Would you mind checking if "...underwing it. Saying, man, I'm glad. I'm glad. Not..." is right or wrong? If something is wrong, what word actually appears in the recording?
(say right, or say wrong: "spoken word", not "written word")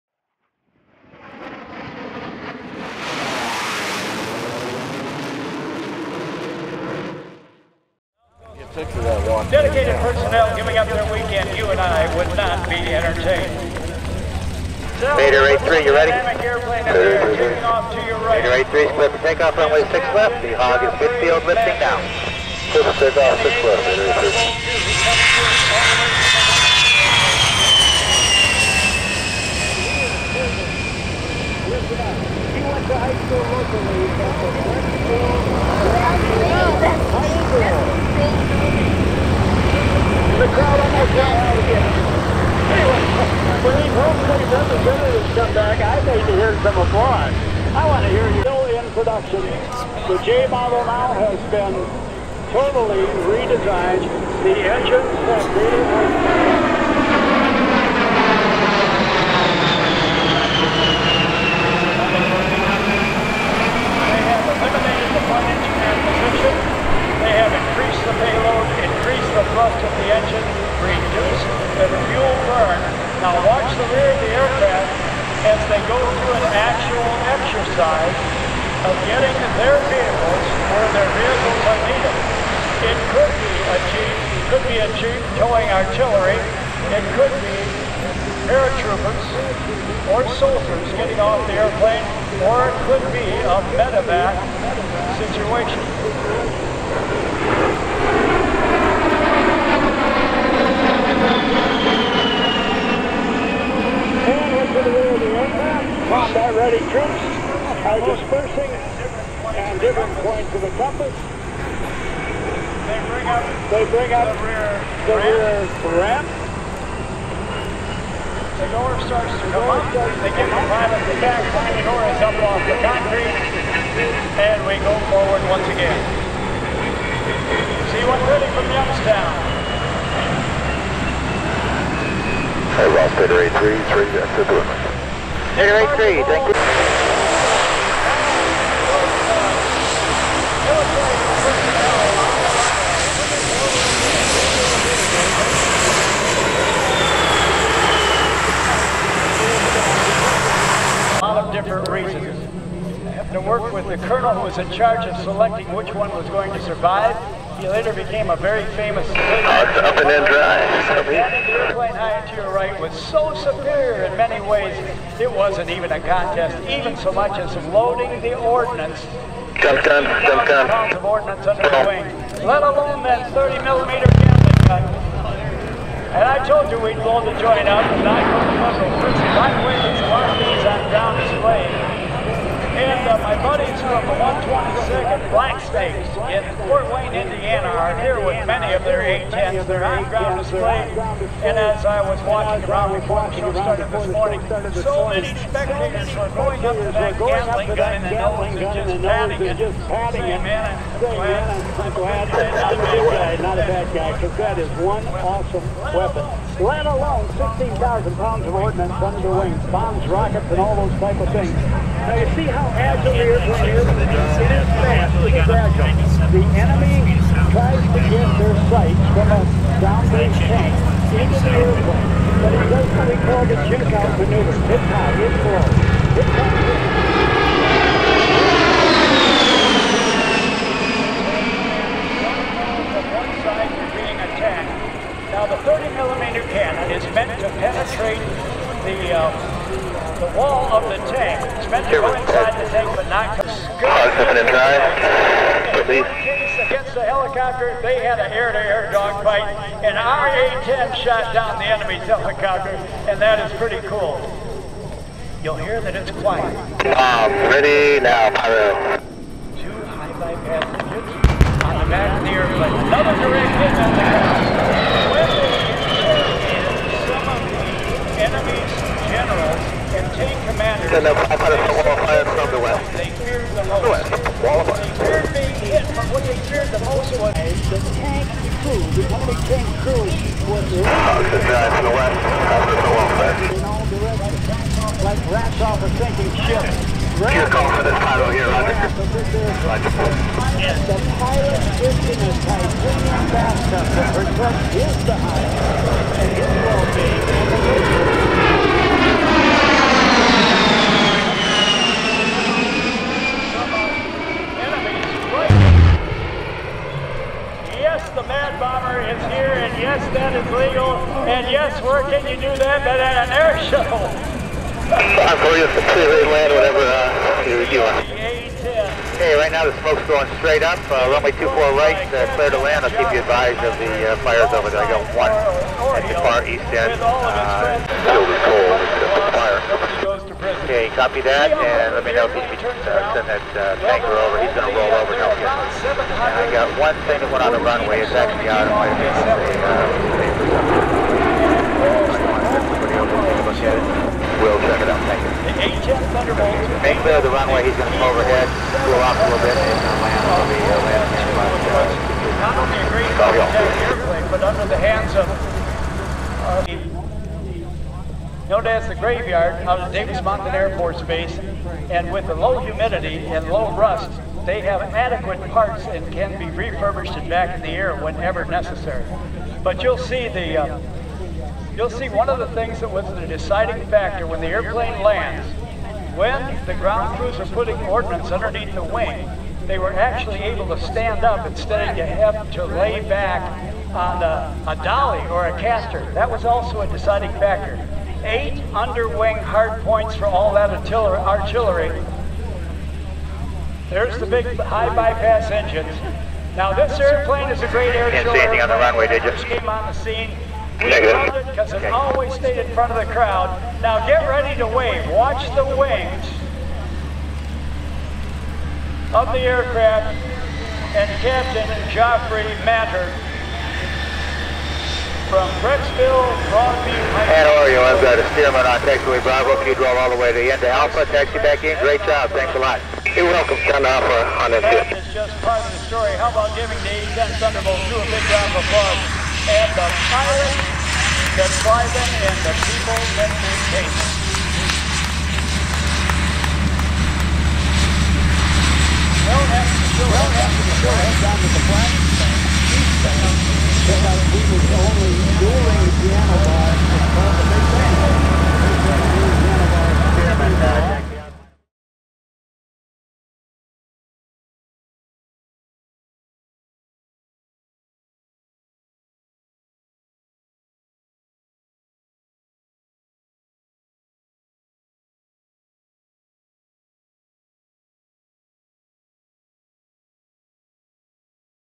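wrong: "patting", not "underwing".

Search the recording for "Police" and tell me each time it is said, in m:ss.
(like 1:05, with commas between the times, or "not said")
4:05.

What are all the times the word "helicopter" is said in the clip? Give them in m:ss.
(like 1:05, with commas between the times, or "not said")
4:07, 4:12.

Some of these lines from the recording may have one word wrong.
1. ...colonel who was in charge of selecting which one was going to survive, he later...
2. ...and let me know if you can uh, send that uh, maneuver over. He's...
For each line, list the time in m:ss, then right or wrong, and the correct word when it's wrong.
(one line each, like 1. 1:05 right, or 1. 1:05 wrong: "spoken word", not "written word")
1. 2:34 right
2. 5:31 wrong: "tanker", not "maneuver".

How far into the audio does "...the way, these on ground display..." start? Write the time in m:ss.
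2:59.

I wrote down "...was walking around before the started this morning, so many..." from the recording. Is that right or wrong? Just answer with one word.
right.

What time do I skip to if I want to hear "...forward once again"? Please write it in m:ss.
2:05.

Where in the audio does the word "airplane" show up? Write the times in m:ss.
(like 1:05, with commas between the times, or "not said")
1:31, 2:41, 3:33, 3:41, 4:22, 5:53, 6:14, 6:36.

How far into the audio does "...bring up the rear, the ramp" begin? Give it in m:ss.
1:53.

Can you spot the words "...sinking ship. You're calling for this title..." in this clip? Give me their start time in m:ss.
4:45.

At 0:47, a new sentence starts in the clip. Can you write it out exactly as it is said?
I want to hear you still in production.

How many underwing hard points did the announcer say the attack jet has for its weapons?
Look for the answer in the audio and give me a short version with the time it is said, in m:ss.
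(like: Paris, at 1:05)
8, at 6:28.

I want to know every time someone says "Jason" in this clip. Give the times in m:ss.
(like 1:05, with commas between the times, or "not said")
not said.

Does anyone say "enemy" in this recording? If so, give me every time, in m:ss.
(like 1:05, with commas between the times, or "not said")
3:36, 4:11.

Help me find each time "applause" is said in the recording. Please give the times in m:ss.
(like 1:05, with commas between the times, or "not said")
0:46, 7:08.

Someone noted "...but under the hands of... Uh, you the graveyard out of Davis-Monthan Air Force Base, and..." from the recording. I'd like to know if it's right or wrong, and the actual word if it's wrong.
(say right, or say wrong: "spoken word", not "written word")
right.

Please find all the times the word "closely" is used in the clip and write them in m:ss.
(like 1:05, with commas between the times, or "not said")
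not said.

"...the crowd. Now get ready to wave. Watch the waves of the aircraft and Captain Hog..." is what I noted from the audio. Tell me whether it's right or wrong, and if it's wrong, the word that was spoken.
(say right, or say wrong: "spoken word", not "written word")
wrong: "Joffrey", not "Hog".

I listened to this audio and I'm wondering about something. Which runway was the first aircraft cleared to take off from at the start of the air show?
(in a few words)
6 left.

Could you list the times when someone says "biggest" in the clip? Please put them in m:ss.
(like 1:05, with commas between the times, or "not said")
not said.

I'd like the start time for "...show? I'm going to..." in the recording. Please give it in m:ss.
5:13.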